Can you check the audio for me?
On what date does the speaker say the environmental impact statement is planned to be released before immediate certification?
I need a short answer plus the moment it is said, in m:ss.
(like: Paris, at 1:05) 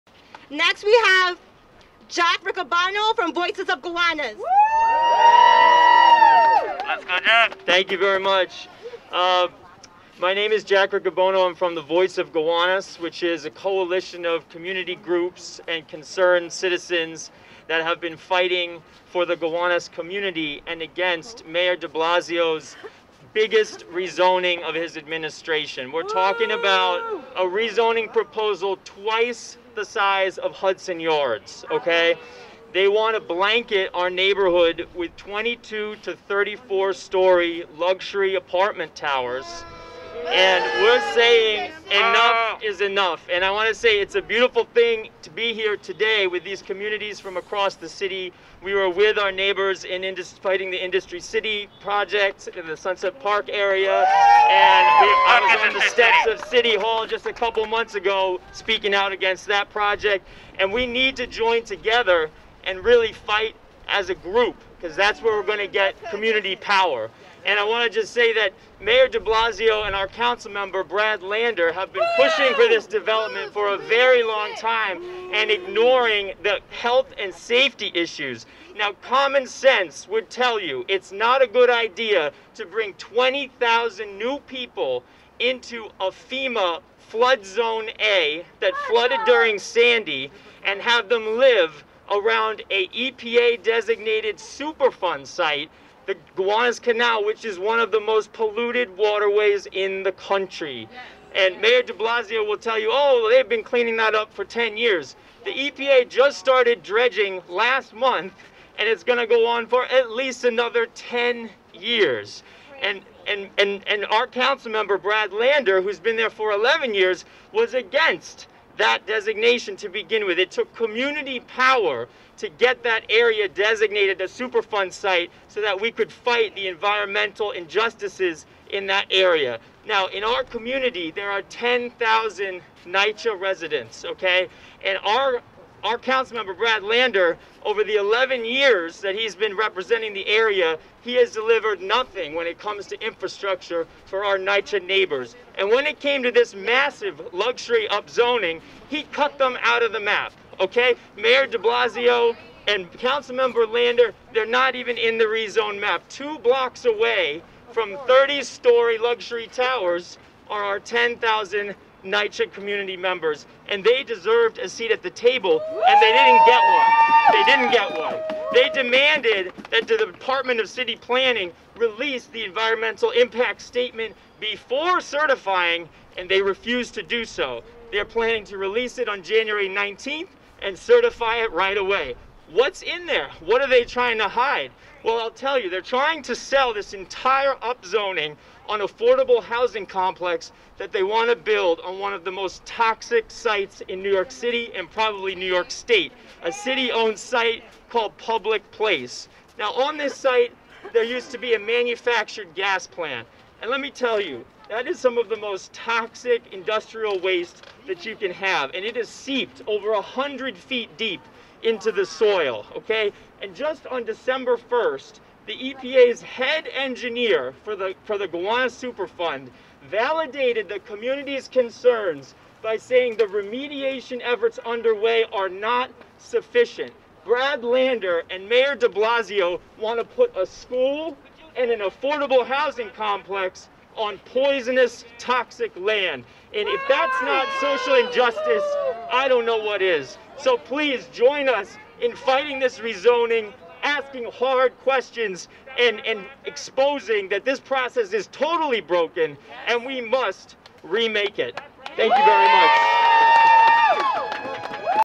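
January 19, at 2:59.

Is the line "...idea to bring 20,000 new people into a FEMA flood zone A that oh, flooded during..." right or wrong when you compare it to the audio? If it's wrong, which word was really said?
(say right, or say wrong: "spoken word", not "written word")
right.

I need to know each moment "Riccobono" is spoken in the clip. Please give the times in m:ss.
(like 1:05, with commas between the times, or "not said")
0:02, 0:10.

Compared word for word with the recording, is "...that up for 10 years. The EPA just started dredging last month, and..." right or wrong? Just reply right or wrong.
right.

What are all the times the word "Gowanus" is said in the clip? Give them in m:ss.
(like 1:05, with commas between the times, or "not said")
0:03, 0:12, 0:19, 1:36, 3:38.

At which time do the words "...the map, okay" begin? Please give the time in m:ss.
2:29.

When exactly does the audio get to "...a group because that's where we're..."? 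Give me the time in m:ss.
1:04.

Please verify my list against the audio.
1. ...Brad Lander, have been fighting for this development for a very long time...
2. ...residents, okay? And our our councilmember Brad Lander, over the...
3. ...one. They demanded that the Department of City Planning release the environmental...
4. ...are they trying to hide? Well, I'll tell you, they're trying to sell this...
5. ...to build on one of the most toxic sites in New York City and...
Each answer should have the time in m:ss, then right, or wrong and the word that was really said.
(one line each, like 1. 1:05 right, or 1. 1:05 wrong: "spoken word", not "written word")
1. 1:10 wrong: "pushing", not "fighting"
2. 2:13 right
3. 2:47 right
4. 3:03 right
5. 3:11 right.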